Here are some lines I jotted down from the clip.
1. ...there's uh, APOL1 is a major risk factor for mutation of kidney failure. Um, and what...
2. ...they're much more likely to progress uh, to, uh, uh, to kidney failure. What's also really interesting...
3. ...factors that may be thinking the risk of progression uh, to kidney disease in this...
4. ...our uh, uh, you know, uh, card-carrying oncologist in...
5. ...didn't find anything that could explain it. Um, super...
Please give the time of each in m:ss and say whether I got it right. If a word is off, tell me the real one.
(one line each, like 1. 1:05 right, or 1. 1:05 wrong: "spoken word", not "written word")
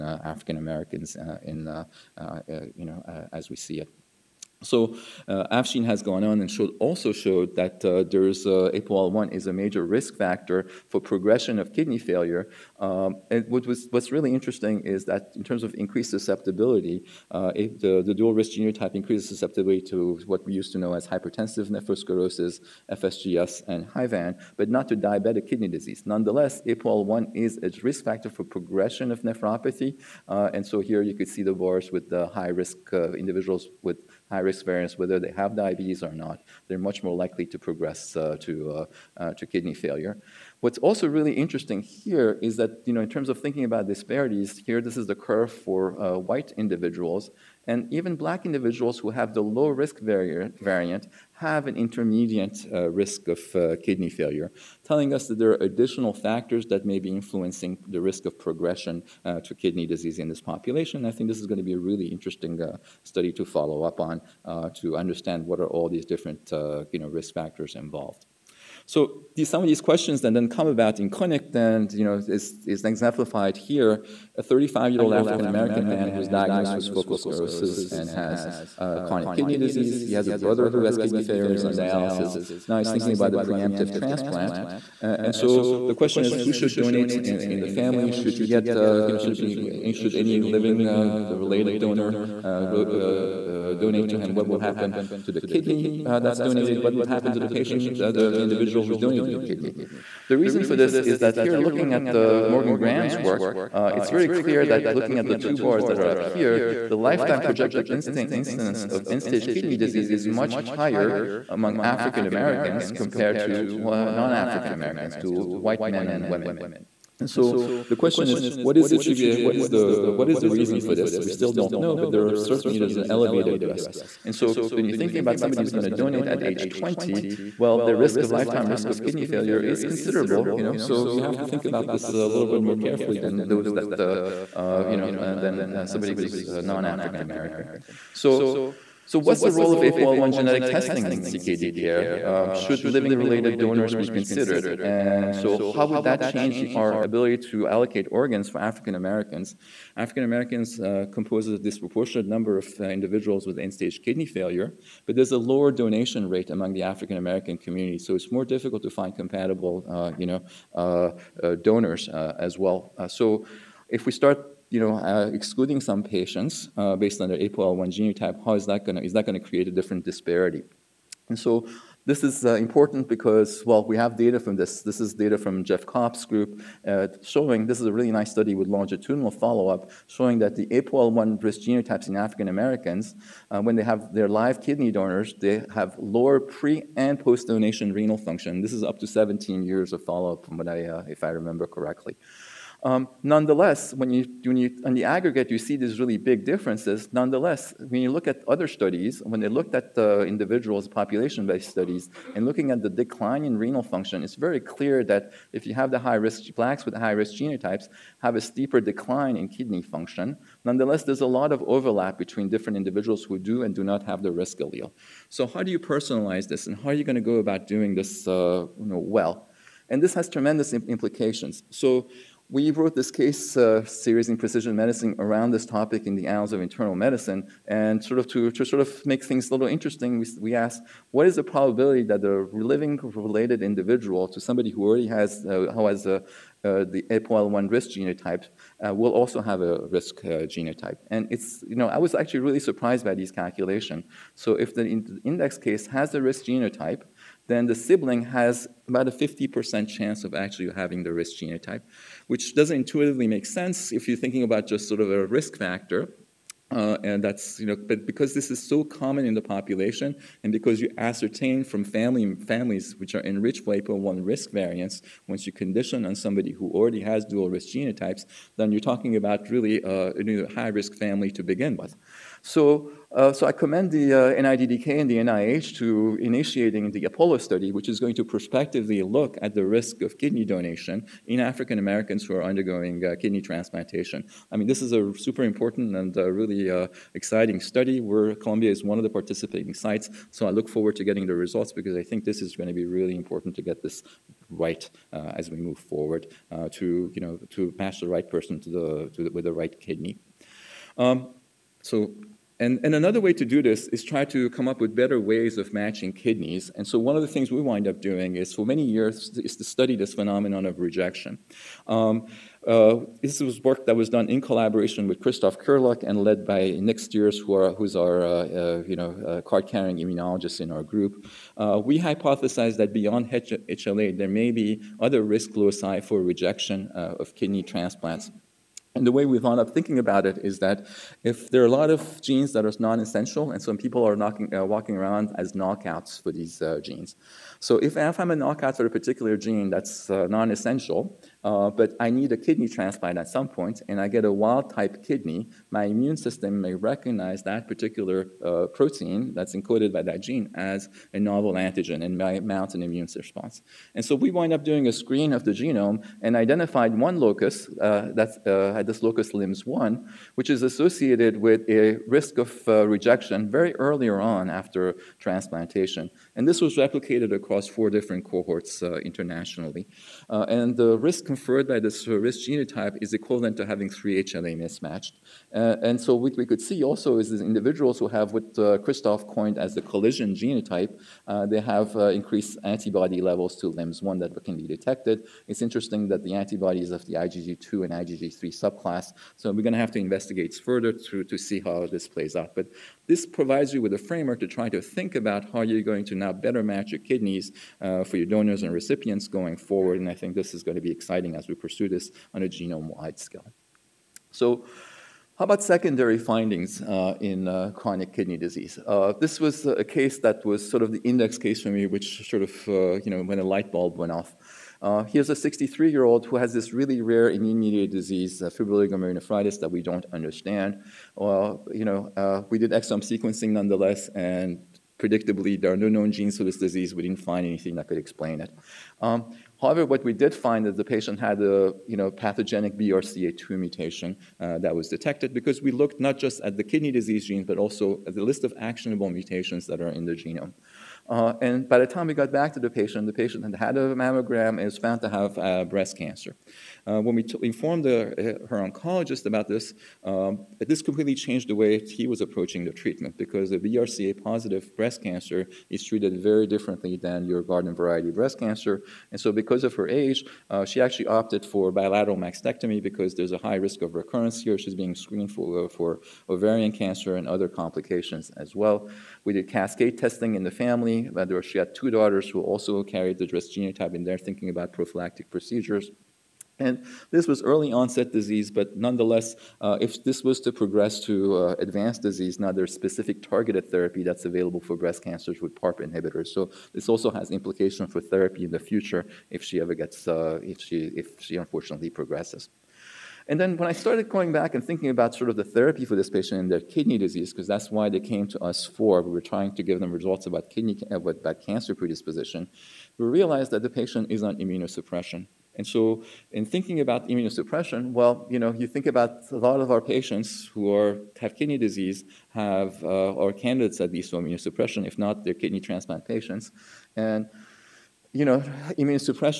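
1. 0:08 wrong: "progression", not "mutation"
2. 0:36 right
3. 0:56 wrong: "influencing", not "thinking"
4. 5:17 wrong: "immunologist", not "oncologist"
5. 7:07 wrong: "however", not "super".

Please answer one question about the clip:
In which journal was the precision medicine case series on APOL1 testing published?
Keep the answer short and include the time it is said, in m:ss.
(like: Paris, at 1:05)
Annals of Internal Medicine, at 3:46.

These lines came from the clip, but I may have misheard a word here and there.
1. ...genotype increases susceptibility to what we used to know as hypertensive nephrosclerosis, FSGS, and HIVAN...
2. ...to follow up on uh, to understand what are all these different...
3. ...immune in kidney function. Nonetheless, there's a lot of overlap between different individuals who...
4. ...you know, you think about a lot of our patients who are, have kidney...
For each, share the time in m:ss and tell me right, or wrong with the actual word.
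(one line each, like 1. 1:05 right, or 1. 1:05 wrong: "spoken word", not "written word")
1. 0:18 right
2. 1:03 right
3. 3:28 wrong: "decline", not "immune"
4. 8:28 right.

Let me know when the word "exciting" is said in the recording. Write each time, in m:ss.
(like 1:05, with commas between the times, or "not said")
4:47, 6:40.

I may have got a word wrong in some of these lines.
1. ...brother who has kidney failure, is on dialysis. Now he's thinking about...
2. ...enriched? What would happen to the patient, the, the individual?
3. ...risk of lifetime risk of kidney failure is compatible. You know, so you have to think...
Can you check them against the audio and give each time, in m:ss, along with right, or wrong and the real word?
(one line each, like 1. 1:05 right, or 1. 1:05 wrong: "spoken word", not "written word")
1. 1:20 right
2. 1:36 wrong: "donated", not "enriched"
3. 2:07 wrong: "considerable", not "compatible".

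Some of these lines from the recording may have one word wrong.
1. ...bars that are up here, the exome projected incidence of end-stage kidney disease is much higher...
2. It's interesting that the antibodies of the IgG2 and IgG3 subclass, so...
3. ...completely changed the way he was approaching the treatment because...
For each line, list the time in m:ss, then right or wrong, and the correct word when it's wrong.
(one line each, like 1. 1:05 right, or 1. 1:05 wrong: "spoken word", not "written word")
1. 1:45 wrong: "lifetime", not "exome"
2. 6:25 right
3. 7:30 right.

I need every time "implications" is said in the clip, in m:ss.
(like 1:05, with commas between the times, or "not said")
3:40, 8:07.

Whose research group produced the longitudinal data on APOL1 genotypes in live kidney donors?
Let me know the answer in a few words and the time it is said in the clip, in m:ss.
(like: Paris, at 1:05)
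Jeff Kopp, at 2:55.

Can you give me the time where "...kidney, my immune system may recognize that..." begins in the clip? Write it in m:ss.
5:45.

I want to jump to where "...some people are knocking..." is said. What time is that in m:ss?
5:33.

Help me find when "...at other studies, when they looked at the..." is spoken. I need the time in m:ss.
3:18.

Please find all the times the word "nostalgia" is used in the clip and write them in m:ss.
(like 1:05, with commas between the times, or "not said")
not said.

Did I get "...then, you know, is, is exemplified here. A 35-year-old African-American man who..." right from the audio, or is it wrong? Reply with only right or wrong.
right.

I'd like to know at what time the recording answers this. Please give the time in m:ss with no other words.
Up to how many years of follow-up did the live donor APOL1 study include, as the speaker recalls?
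3:09.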